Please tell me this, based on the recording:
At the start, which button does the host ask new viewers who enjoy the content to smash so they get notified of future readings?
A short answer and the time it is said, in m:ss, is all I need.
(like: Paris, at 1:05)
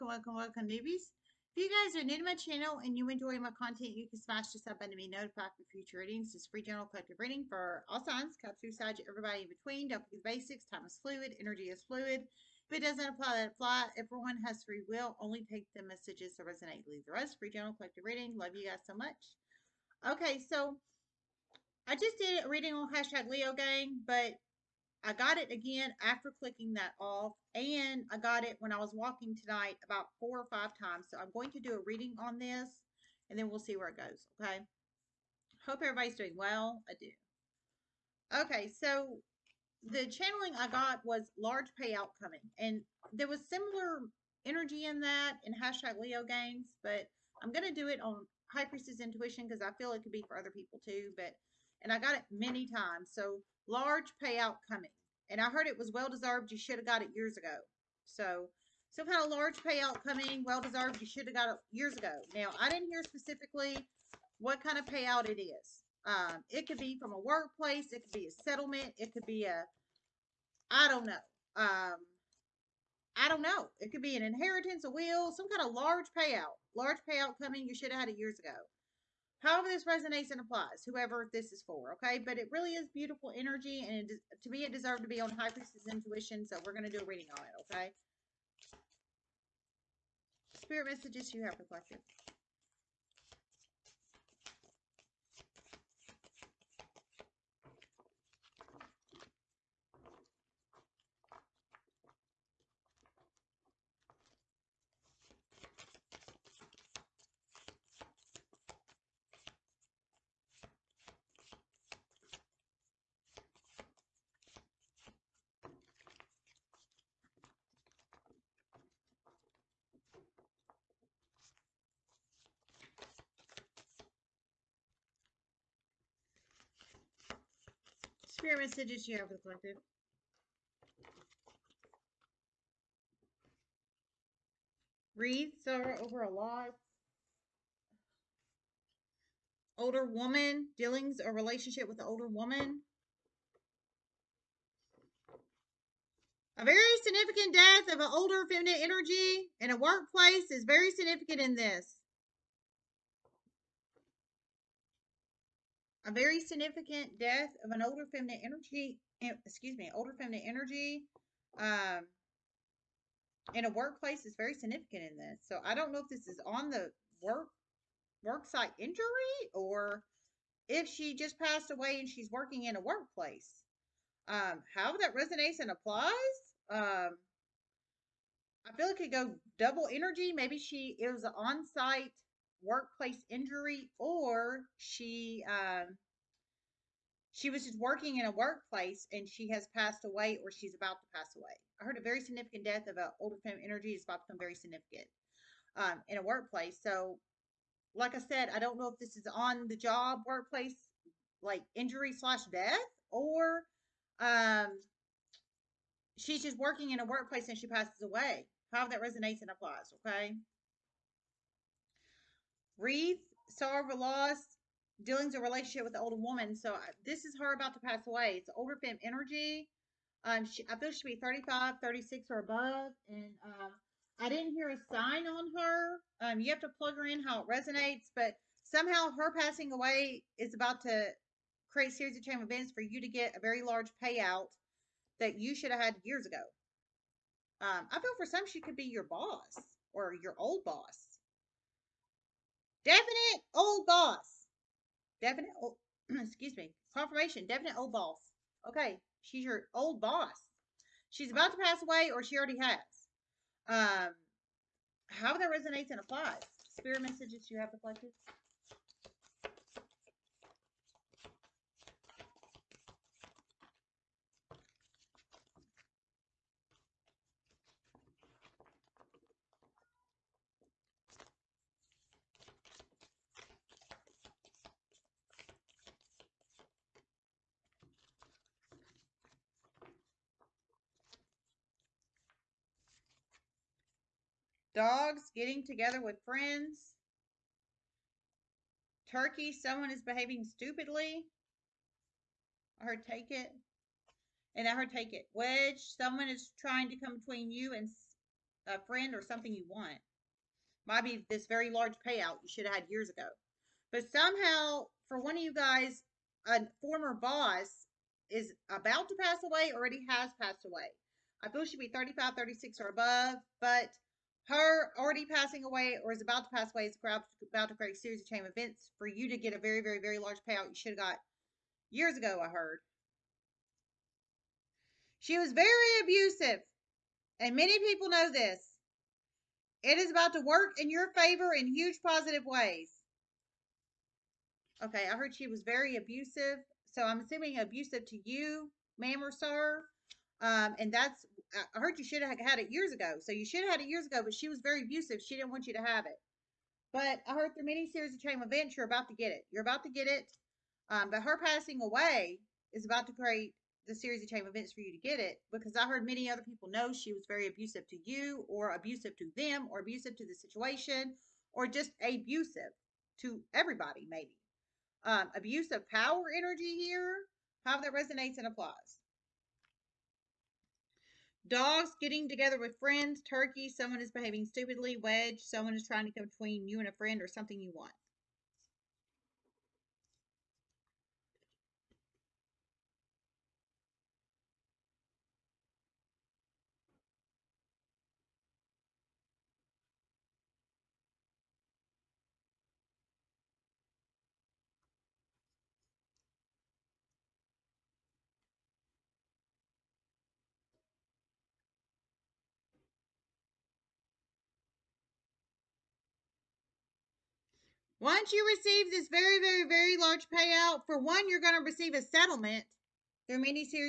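sub button, at 0:04.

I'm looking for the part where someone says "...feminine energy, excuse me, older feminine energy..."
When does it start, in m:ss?
2:38.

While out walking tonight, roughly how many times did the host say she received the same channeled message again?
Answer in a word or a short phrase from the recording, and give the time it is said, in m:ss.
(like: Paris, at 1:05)
4 or 5 times, at 0:30.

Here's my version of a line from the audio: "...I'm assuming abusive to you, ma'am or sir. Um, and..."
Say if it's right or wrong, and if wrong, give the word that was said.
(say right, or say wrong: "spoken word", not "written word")
right.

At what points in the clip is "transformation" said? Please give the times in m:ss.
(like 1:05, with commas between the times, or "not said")
not said.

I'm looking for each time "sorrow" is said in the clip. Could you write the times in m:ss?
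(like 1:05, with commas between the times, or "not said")
2:15, 3:33.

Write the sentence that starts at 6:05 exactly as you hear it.
Um, abuse of power energy here, how that resonates and applies.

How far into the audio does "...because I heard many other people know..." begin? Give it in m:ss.
5:55.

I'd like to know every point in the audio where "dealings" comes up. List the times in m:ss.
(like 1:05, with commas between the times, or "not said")
2:20, 3:35.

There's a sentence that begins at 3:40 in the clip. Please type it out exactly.
Um, she, I feel she should be 35, 36 or above.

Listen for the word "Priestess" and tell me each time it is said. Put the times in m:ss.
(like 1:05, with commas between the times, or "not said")
0:48, 1:25.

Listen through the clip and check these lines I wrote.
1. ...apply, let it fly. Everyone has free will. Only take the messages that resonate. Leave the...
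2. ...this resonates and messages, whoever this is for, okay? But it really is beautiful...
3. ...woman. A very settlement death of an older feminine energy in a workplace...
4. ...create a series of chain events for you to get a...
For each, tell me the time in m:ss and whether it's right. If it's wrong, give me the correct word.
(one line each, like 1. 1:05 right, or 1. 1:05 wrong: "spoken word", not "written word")
1. 0:13 right
2. 1:19 wrong: "applies", not "messages"
3. 2:22 wrong: "significant", not "settlement"
4. 5:17 right.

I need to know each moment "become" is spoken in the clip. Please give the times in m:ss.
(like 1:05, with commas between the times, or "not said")
3:14.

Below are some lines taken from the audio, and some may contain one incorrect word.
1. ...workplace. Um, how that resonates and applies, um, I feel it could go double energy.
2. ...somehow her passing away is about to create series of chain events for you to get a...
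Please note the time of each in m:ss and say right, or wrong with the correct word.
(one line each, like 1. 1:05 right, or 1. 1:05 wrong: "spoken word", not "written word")
1. 2:52 right
2. 3:48 right.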